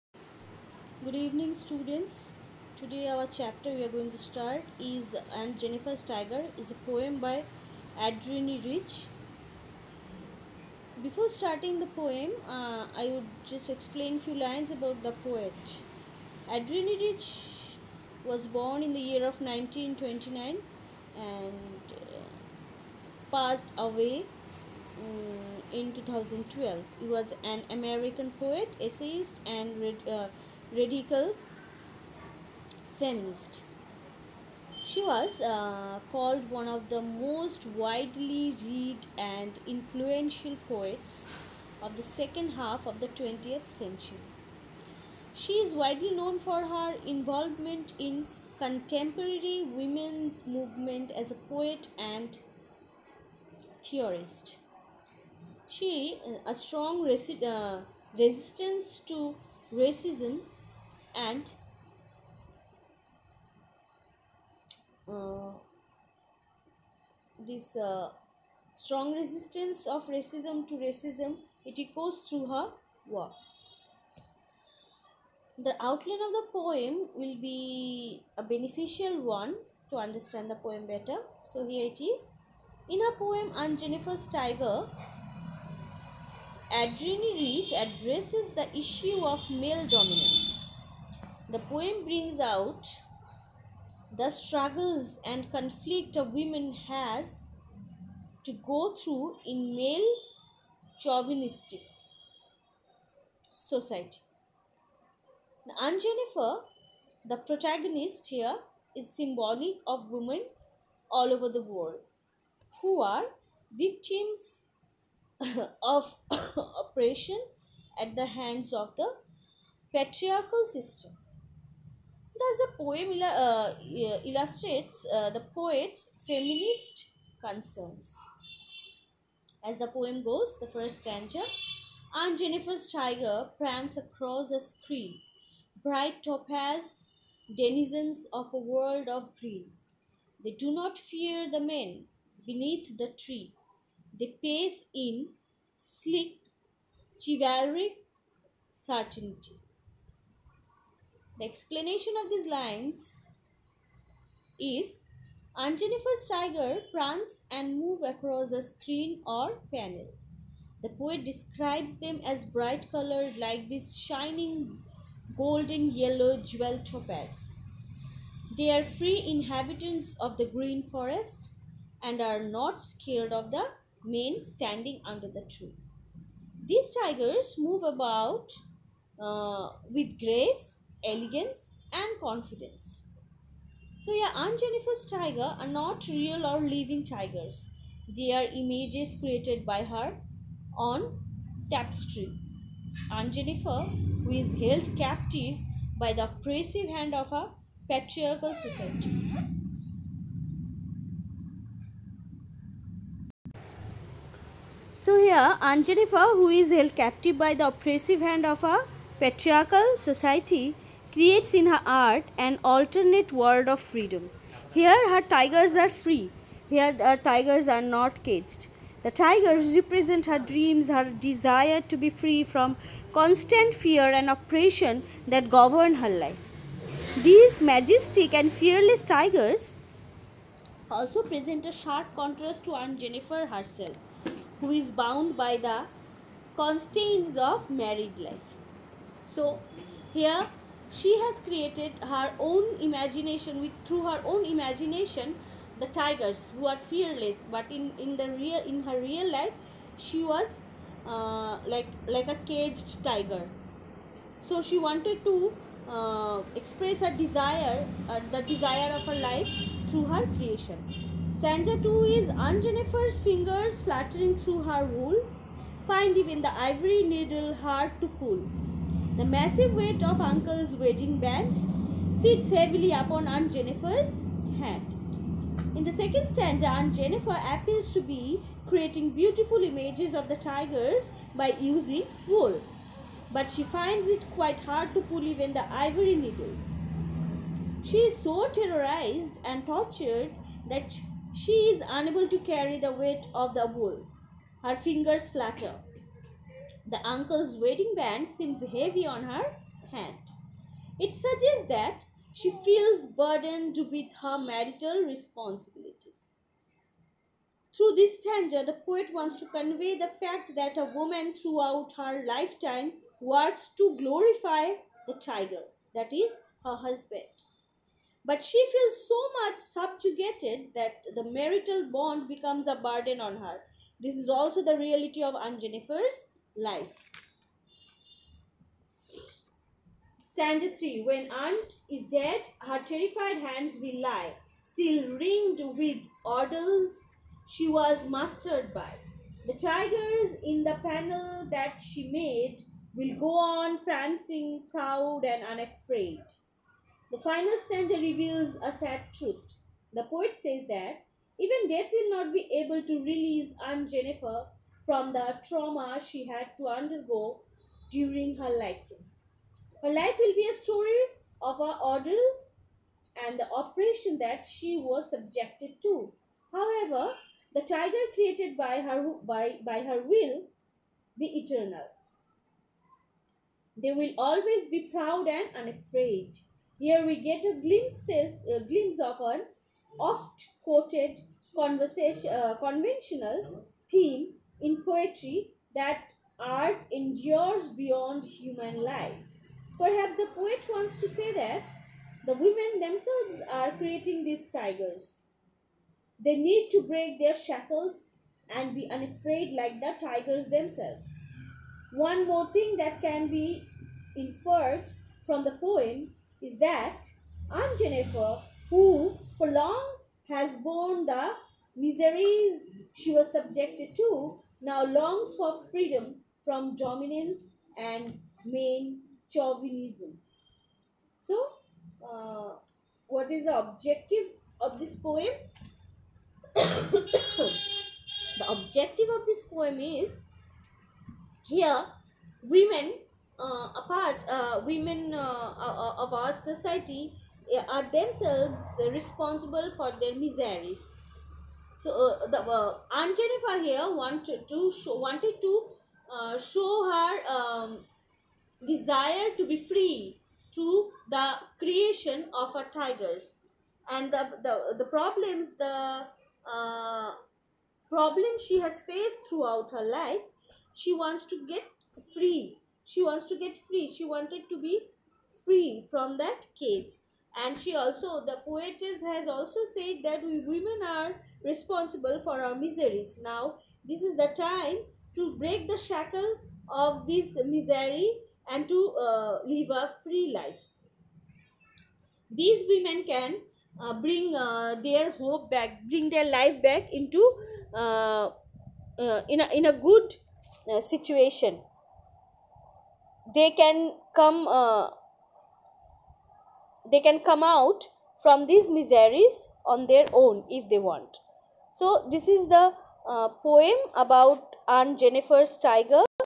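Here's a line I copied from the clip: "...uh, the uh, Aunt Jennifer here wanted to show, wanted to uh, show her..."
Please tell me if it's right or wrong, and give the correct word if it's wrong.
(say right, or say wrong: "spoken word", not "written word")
right.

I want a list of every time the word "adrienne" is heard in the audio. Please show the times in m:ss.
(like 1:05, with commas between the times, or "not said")
0:08, 0:16, 1:26.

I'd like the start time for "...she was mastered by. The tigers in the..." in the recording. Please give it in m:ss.
5:37.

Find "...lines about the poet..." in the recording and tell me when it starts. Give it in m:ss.
0:14.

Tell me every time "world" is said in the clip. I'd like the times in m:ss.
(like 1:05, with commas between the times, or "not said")
1:51, 2:18, 3:33.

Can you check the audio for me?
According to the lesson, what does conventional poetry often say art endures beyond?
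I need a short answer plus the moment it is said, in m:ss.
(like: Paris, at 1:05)
Human life, at 6:28.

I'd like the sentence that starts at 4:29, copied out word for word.
The massive weight of uncle's wedding band sits heavily upon Aunt Jennifer's hand.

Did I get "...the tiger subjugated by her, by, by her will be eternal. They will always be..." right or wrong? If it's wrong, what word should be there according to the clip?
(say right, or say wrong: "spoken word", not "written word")
wrong: "created", not "subjugated".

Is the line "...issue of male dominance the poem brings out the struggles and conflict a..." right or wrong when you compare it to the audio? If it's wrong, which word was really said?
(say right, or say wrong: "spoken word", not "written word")
right.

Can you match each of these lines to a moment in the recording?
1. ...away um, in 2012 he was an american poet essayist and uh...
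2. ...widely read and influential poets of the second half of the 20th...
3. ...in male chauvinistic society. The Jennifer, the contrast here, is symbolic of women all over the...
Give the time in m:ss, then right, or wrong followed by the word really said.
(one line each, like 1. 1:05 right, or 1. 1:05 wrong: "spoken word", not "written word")
1. 0:23 right
2. 0:37 right
3. 1:39 wrong: "protagonist", not "contrast".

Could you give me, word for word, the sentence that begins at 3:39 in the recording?
The tigers represent her dreams, her desire to be free from constant fear and oppression that govern her life.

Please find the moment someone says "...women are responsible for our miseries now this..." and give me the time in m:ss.
7:50.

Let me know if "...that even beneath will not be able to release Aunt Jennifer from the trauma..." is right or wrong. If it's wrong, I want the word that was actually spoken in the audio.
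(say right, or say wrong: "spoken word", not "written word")
wrong: "death", not "beneath".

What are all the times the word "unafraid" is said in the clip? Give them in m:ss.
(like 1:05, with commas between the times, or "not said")
5:45, 6:15, 6:38.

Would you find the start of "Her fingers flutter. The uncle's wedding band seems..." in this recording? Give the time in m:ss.
4:54.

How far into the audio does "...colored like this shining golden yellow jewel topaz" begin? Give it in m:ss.
2:42.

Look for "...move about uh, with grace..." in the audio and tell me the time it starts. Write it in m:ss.
2:57.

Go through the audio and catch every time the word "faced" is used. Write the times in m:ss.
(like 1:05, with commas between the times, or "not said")
7:38.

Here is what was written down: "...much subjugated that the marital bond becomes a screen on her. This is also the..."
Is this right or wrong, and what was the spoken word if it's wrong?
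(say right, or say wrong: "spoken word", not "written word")
wrong: "burden", not "screen".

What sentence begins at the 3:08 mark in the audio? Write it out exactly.
They are images created by her on tapestry.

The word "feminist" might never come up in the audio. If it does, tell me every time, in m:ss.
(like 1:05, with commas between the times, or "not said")
0:32, 2:06.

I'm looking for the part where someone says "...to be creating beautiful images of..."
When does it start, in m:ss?
4:37.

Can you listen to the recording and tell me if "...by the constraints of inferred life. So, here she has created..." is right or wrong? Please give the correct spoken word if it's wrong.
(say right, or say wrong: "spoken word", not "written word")
wrong: "married", not "inferred".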